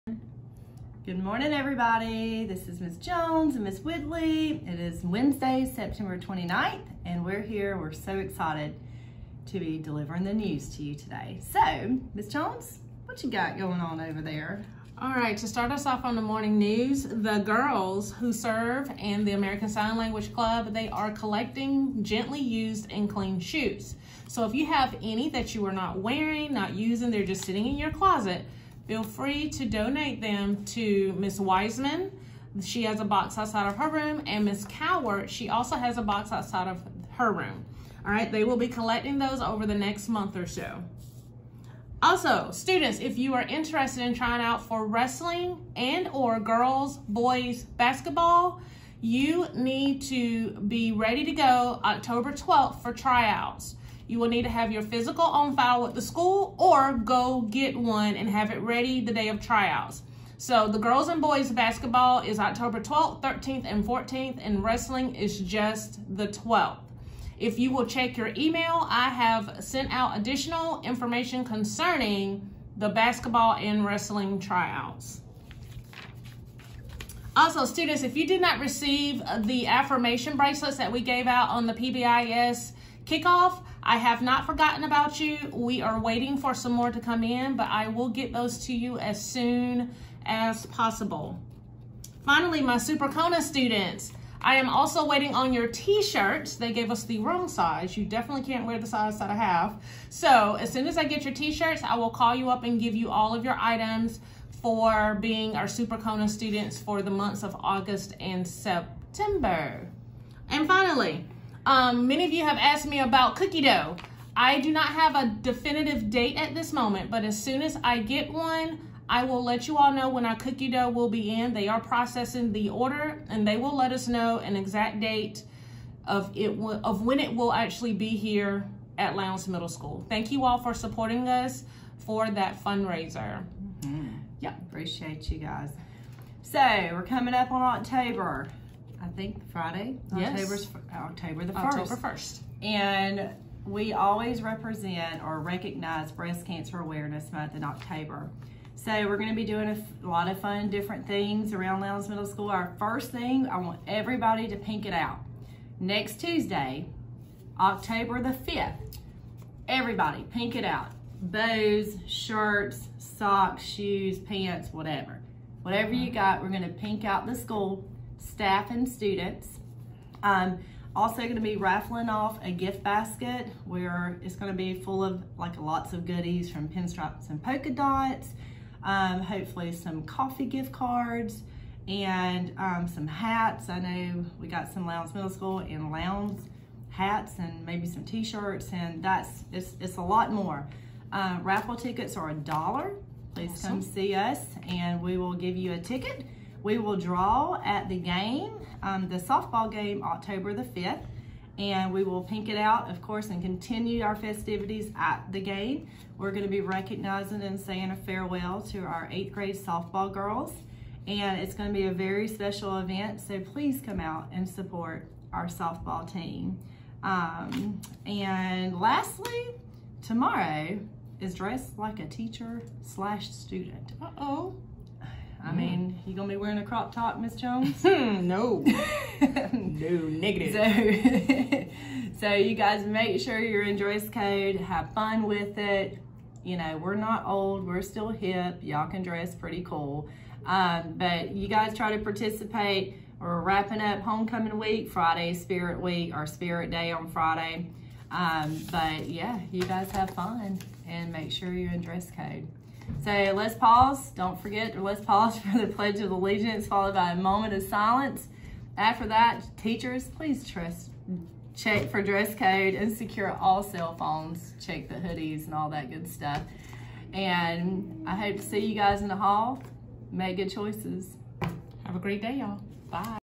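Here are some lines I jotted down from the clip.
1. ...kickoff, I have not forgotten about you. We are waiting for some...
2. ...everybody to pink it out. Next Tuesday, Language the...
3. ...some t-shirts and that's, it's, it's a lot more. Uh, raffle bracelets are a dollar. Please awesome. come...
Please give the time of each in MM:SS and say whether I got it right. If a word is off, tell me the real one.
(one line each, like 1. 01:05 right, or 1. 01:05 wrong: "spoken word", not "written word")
1. 01:23 right
2. 02:33 wrong: "October", not "Language"
3. 03:07 wrong: "tickets", not "bracelets".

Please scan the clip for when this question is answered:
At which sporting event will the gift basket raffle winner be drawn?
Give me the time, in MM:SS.
03:19.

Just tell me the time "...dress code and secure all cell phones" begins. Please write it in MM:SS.
04:22.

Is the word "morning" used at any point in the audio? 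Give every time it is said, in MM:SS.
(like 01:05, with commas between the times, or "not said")
00:01, 00:16.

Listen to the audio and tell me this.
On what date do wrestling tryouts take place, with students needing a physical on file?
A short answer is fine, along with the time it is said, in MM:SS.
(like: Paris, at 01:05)
October 12th, at 01:05.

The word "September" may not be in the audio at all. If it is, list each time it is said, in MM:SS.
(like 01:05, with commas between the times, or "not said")
00:05, 01:48.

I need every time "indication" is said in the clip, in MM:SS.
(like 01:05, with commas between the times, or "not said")
not said.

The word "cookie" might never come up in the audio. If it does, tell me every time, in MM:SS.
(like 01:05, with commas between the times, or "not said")
01:53, 02:00.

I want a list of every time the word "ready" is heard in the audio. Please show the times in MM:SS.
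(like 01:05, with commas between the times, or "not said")
00:50, 00:58.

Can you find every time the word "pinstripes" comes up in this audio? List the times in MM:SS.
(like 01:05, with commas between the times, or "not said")
02:56.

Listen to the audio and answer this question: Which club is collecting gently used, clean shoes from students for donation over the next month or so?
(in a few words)
American Sign Language Club.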